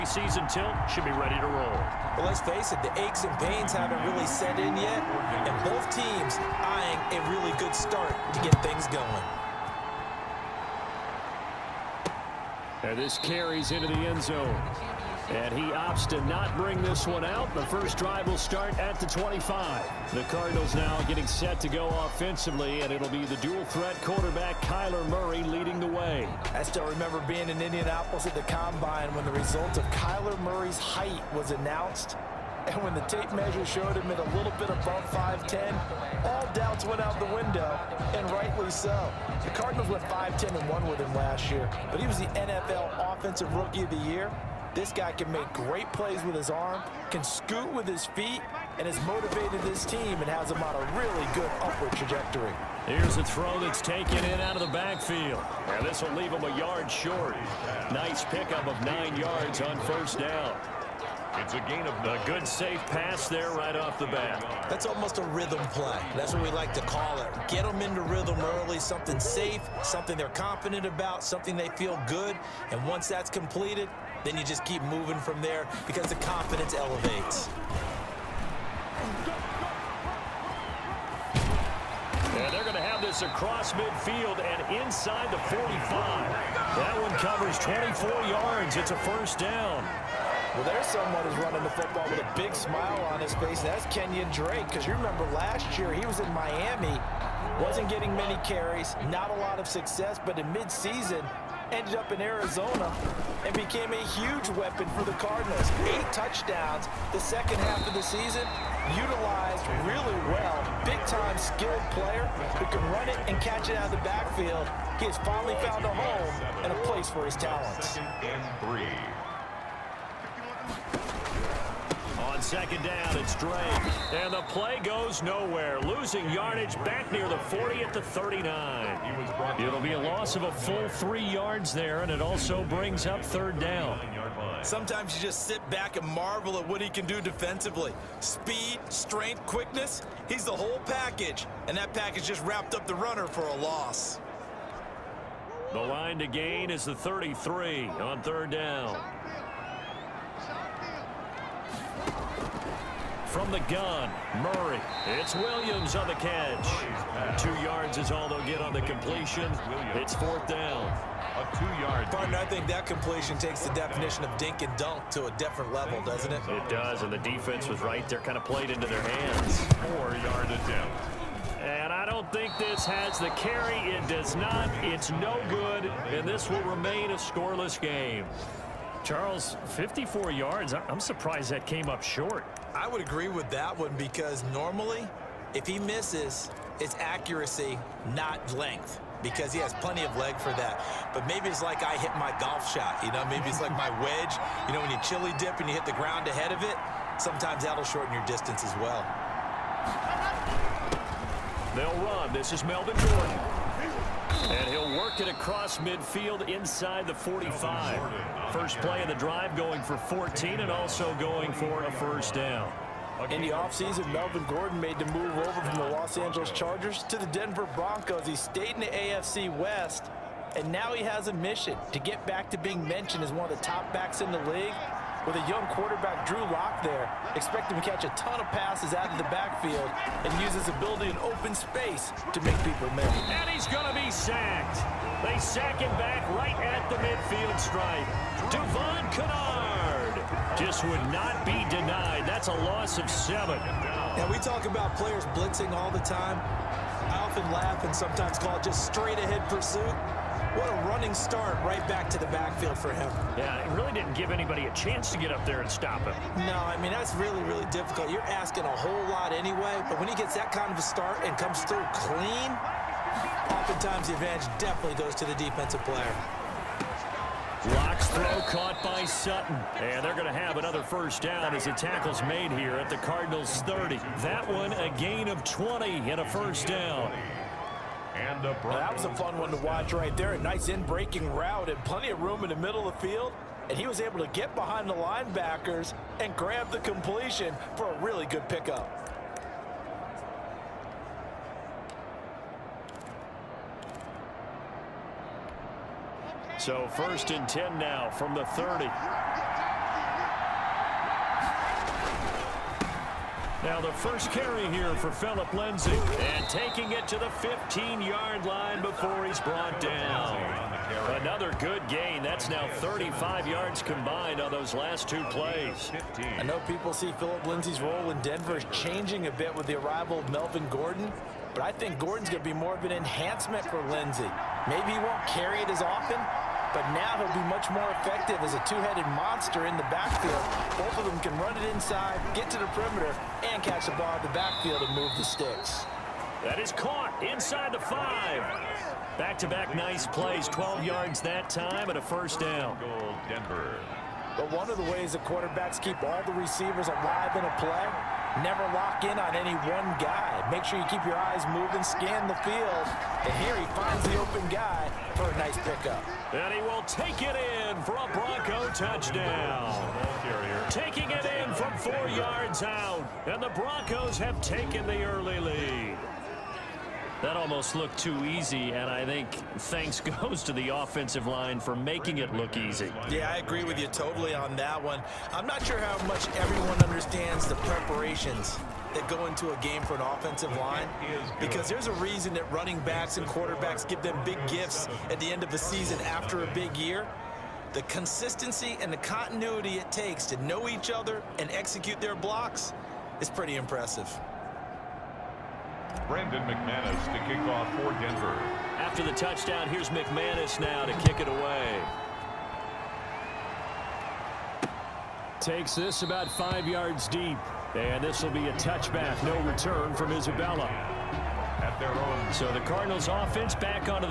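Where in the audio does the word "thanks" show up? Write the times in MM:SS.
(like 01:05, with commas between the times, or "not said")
06:09.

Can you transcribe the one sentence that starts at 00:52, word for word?
Here's a throw that's taken in out of the backfield.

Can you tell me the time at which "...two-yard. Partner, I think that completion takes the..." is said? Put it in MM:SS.
02:41.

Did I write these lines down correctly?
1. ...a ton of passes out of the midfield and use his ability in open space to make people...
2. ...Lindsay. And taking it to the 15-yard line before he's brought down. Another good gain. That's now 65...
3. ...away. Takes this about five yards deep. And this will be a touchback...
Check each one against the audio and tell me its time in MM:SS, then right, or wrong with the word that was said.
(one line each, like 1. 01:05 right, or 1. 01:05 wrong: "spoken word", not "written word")
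1. 03:48 wrong: "backfield", not "midfield"
2. 05:05 wrong: "35", not "65"
3. 06:41 right.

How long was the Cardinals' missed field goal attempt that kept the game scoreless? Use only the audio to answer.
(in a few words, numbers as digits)
54 yards.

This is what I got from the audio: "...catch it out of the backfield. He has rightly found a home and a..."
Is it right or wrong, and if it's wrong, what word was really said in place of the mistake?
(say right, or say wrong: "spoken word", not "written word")
wrong: "finally", not "rightly".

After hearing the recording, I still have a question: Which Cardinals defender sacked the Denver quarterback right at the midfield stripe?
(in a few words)
Devon Kennard.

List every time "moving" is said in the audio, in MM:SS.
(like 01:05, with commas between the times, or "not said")
01:14, 05:51.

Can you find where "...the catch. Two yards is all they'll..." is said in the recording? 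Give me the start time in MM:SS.
02:36.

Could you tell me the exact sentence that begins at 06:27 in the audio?
The consistency and the continuity it takes to know each other and execute their blocks is pretty impressive.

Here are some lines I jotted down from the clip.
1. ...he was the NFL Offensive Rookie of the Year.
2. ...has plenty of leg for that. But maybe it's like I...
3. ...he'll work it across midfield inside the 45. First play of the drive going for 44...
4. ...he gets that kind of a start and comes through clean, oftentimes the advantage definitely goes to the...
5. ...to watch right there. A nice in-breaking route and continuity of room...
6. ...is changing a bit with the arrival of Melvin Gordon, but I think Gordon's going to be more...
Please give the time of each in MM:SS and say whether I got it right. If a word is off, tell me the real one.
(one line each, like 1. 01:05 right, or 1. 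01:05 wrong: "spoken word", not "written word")
1. 00:41 right
2. 03:09 right
3. 03:24 wrong: "14", not "44"
4. 04:20 right
5. 04:39 wrong: "plenty", not "continuity"
6. 05:18 right.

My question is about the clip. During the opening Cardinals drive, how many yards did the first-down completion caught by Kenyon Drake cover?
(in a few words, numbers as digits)
24.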